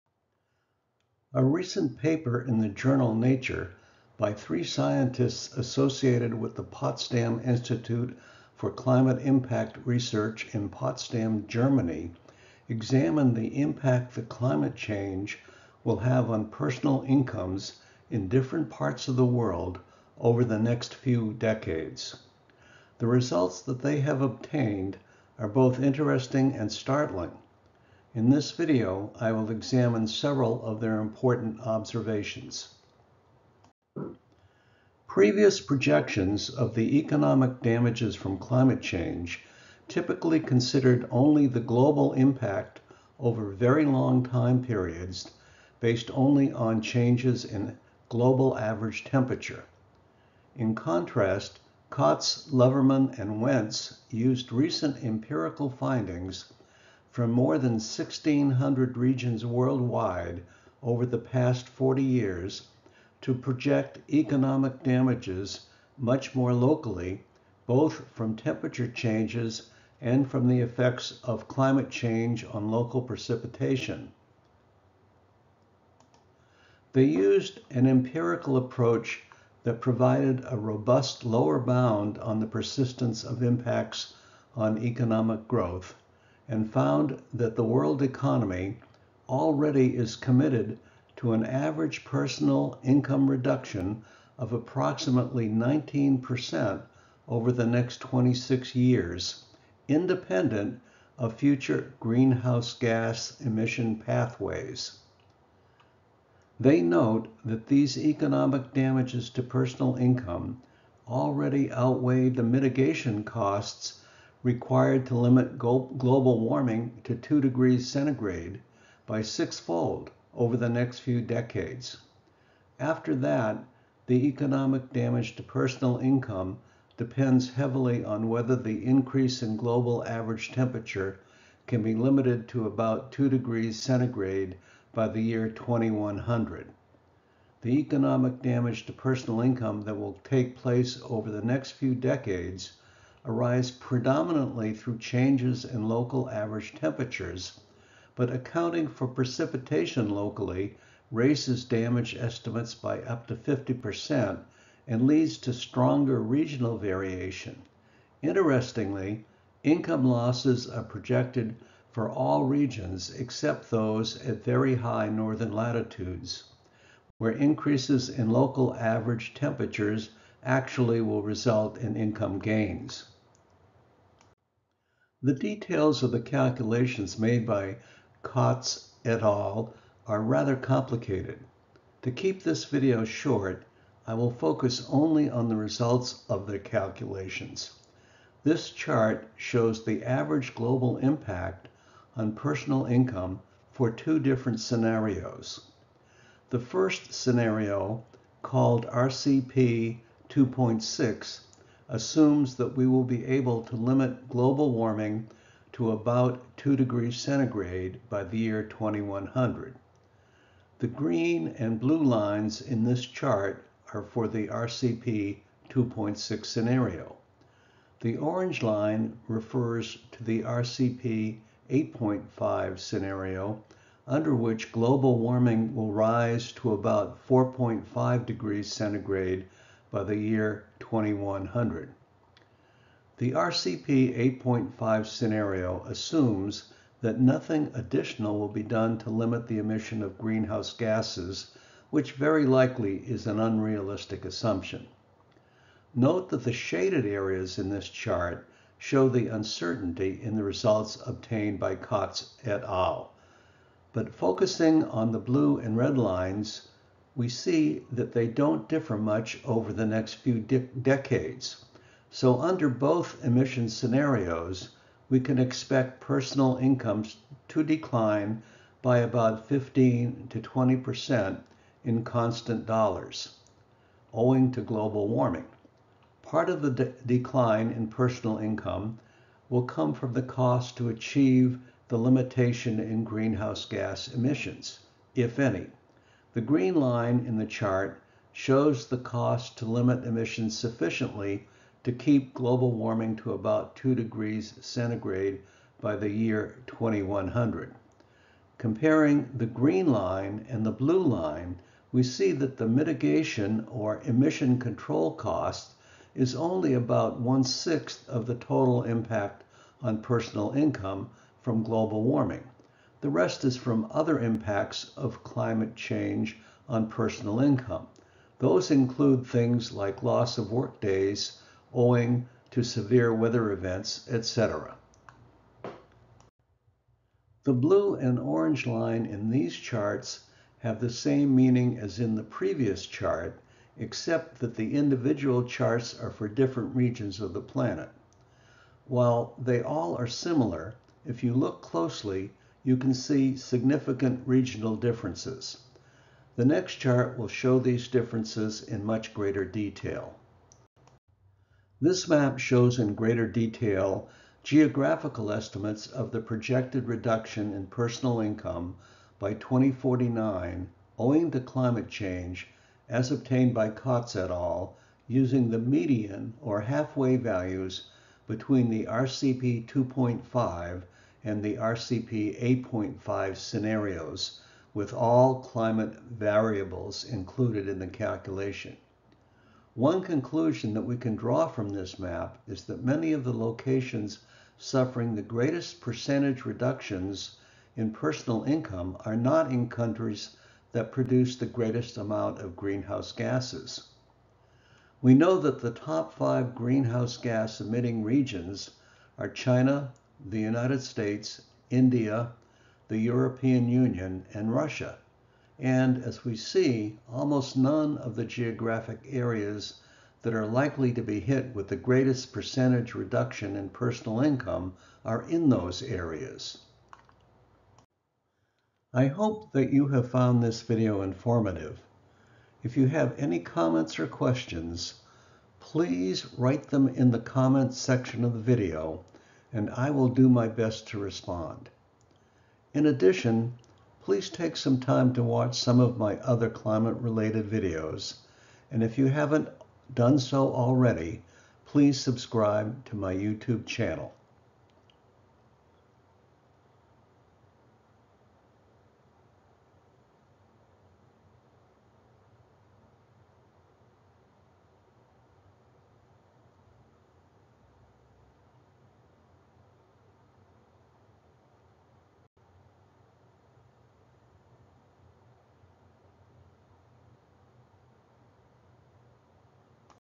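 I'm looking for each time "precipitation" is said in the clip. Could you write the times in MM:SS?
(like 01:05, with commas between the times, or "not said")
01:13, 02:29.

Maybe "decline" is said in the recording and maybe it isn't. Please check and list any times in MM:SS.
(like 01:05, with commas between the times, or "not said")
04:27, 04:37.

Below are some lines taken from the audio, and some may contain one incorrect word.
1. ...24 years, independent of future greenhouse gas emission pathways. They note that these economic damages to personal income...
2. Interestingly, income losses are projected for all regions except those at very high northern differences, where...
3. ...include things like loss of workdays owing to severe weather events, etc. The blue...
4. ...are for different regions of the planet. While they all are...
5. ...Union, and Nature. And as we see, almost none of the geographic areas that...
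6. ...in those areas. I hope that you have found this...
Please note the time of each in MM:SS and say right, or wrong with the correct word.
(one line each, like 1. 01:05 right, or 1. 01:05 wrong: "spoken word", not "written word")
1. 01:38 wrong: "26", not "24"
2. 02:38 wrong: "latitudes", not "differences"
3. 05:18 right
4. 05:35 right
5. 06:43 wrong: "Russia", not "Nature"
6. 06:55 right.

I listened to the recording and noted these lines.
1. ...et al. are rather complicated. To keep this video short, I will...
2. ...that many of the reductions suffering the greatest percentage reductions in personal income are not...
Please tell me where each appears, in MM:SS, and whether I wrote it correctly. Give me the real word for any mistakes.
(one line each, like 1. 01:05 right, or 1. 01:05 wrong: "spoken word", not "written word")
1. 02:59 right
2. 06:22 wrong: "locations", not "reductions".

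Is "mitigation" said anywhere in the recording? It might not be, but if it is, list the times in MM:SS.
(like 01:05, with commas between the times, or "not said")
01:52, 05:02.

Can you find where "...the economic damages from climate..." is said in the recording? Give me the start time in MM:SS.
00:36.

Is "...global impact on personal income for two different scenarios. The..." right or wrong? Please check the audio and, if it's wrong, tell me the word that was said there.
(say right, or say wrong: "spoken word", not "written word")
right.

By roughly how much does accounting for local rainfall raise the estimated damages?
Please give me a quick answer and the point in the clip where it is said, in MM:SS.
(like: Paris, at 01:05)
up to 50%, at 02:33.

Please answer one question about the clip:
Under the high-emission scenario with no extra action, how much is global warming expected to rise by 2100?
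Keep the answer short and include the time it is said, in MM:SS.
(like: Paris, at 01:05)
4.5 degrees centigrade, at 03:47.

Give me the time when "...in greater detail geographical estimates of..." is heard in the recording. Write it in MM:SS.
05:52.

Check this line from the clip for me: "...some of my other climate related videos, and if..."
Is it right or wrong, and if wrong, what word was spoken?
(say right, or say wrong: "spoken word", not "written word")
right.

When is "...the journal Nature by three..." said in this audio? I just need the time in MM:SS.
00:02.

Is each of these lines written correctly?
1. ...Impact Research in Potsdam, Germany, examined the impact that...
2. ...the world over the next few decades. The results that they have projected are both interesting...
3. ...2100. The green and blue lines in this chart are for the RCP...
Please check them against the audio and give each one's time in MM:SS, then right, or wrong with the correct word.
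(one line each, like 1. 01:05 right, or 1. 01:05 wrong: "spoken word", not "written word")
1. 00:09 right
2. 00:19 wrong: "obtained", not "projected"
3. 03:28 right.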